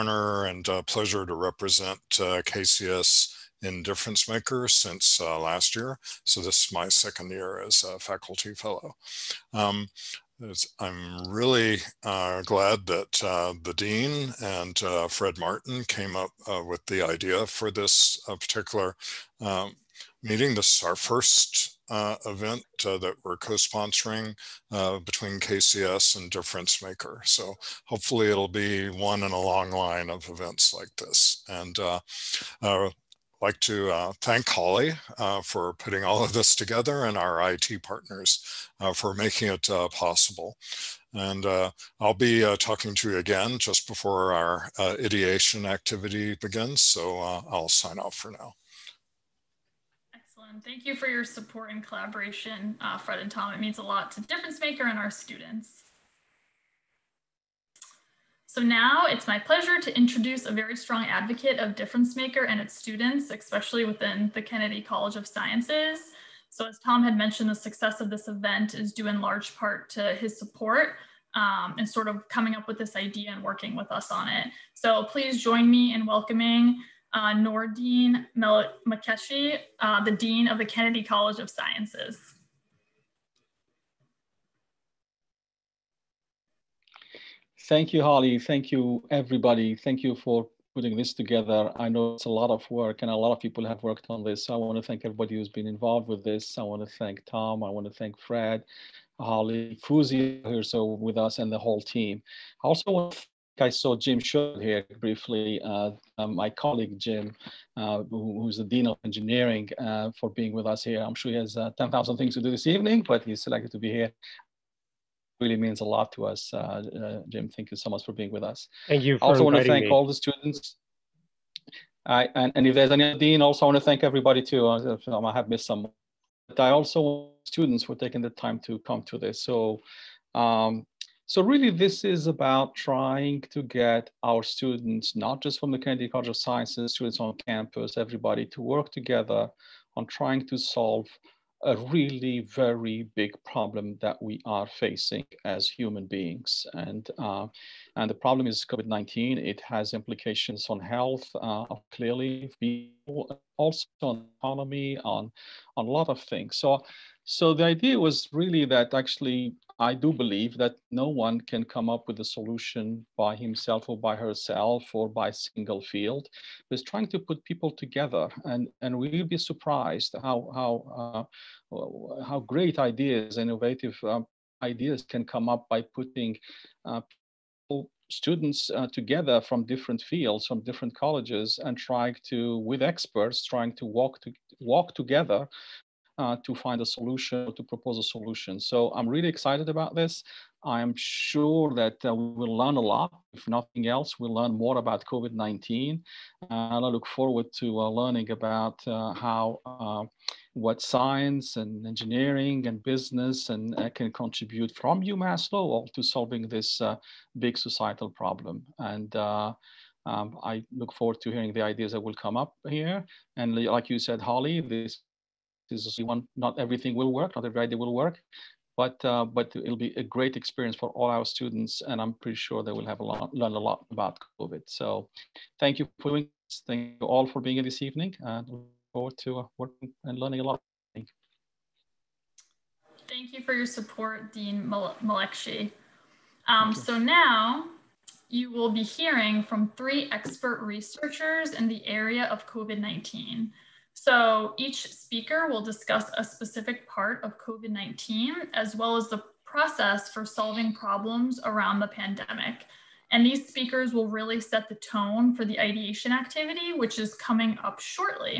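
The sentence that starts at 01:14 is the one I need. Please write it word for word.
So please join me in welcoming uh, Nordine Mel Makeshi, uh, the Dean of the Kennedy College of Sciences.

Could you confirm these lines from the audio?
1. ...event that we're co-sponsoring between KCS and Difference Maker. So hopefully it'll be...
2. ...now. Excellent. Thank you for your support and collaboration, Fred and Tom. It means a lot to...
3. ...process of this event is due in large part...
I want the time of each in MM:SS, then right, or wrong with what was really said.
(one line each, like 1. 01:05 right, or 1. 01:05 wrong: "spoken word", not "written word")
1. 00:22 right
2. 00:48 right
3. 01:07 wrong: "success", not "process".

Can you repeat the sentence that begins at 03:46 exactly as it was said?
Thank you all for being here this evening and look forward to uh, working and learning a lot.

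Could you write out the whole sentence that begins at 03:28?
And um, I look forward to hearing the ideas that will come up here.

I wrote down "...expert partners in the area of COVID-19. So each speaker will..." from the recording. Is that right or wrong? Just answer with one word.
wrong.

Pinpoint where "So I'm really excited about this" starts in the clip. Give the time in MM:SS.
03:08.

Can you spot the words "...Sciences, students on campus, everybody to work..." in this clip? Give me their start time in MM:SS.
02:16.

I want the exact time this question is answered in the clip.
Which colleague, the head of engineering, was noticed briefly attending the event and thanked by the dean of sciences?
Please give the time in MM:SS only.
01:43.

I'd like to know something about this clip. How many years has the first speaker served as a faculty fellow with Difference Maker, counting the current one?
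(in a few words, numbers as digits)
second year.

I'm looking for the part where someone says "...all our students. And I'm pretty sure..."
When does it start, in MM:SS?
03:40.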